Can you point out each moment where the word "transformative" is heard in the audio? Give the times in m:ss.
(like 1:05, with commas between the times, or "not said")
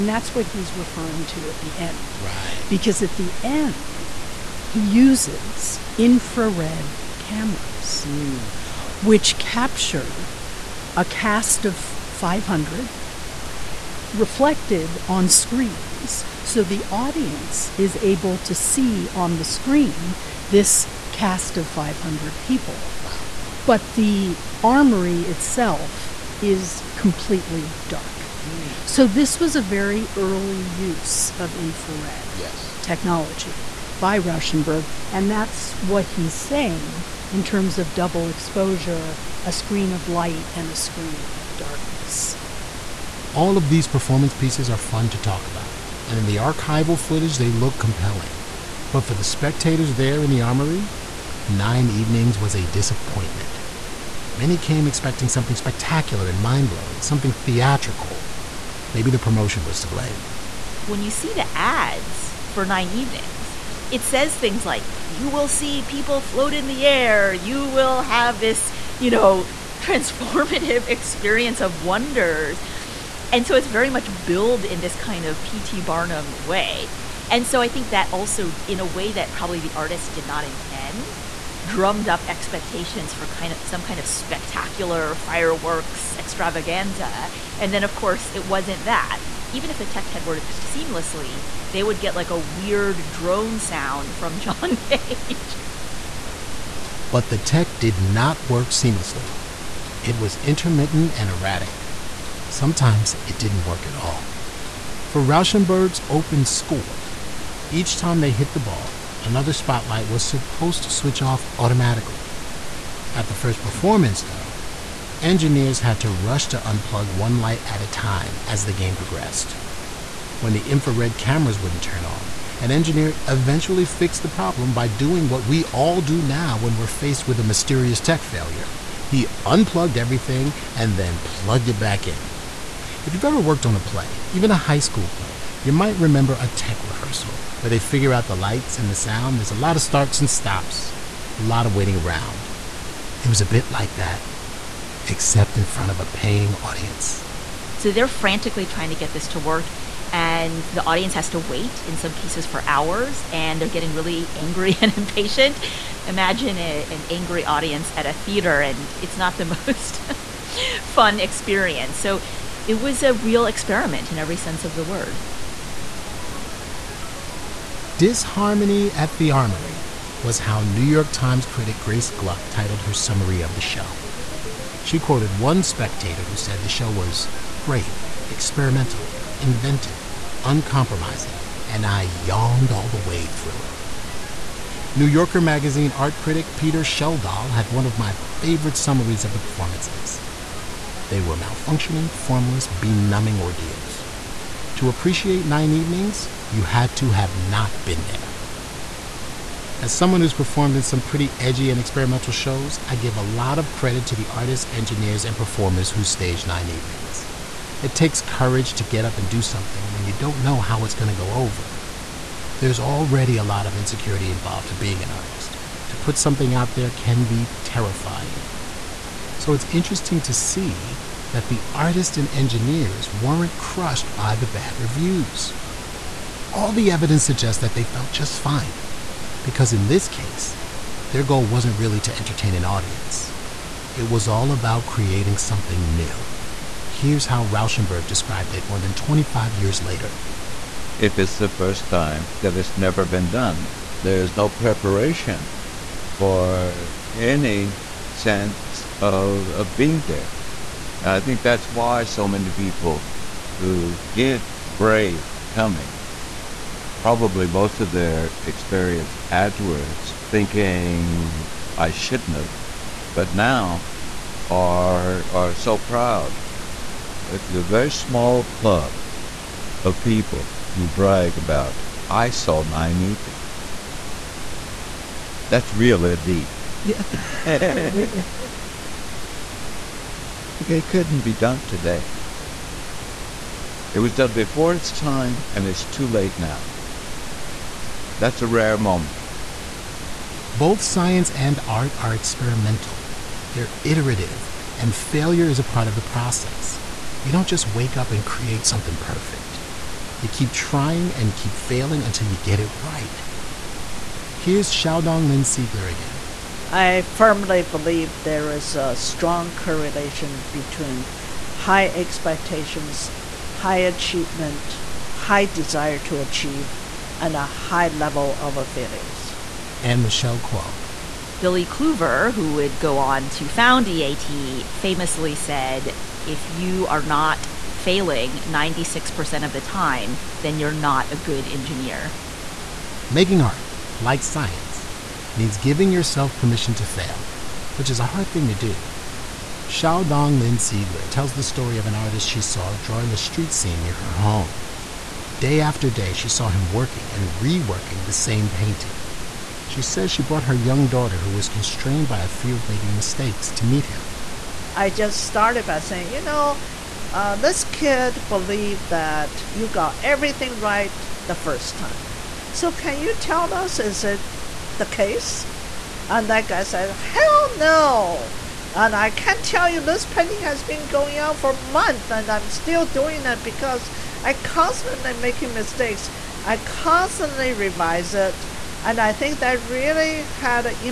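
1:09.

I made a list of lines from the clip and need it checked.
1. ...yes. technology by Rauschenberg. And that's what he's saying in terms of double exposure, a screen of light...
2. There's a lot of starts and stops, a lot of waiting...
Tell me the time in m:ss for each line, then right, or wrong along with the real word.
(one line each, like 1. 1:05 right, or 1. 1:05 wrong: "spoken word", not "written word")
1. 0:32 right
2. 2:19 right.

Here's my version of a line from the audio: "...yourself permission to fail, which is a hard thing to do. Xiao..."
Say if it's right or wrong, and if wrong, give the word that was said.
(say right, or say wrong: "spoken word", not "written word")
right.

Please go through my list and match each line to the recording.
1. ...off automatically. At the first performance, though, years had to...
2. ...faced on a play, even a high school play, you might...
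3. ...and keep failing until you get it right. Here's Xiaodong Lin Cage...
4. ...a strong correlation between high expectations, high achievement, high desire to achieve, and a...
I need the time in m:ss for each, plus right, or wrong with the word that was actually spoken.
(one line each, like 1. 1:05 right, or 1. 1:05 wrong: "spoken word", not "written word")
1. 1:51 wrong: "engineers", not "years"
2. 2:13 wrong: "worked", not "faced"
3. 5:01 wrong: "Siegler", not "Cage"
4. 5:08 right.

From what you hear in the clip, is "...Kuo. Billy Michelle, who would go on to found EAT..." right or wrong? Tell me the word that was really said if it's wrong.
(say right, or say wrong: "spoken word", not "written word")
wrong: "Kluver", not "Michelle".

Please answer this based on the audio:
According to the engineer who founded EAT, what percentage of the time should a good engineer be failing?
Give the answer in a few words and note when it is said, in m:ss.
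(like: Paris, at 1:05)
96%, at 5:28.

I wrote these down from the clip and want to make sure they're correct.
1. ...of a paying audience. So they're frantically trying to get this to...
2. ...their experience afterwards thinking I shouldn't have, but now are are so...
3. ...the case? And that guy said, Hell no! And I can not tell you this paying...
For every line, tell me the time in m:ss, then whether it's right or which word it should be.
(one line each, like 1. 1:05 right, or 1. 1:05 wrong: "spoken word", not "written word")
1. 2:25 right
2. 4:17 right
3. 6:04 wrong: "painting", not "paying".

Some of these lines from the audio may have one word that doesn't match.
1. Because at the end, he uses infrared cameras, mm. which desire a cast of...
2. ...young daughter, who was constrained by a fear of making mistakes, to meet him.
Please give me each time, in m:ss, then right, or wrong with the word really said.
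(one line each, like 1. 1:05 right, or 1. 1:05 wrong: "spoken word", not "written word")
1. 0:02 wrong: "capture", not "desire"
2. 5:50 right.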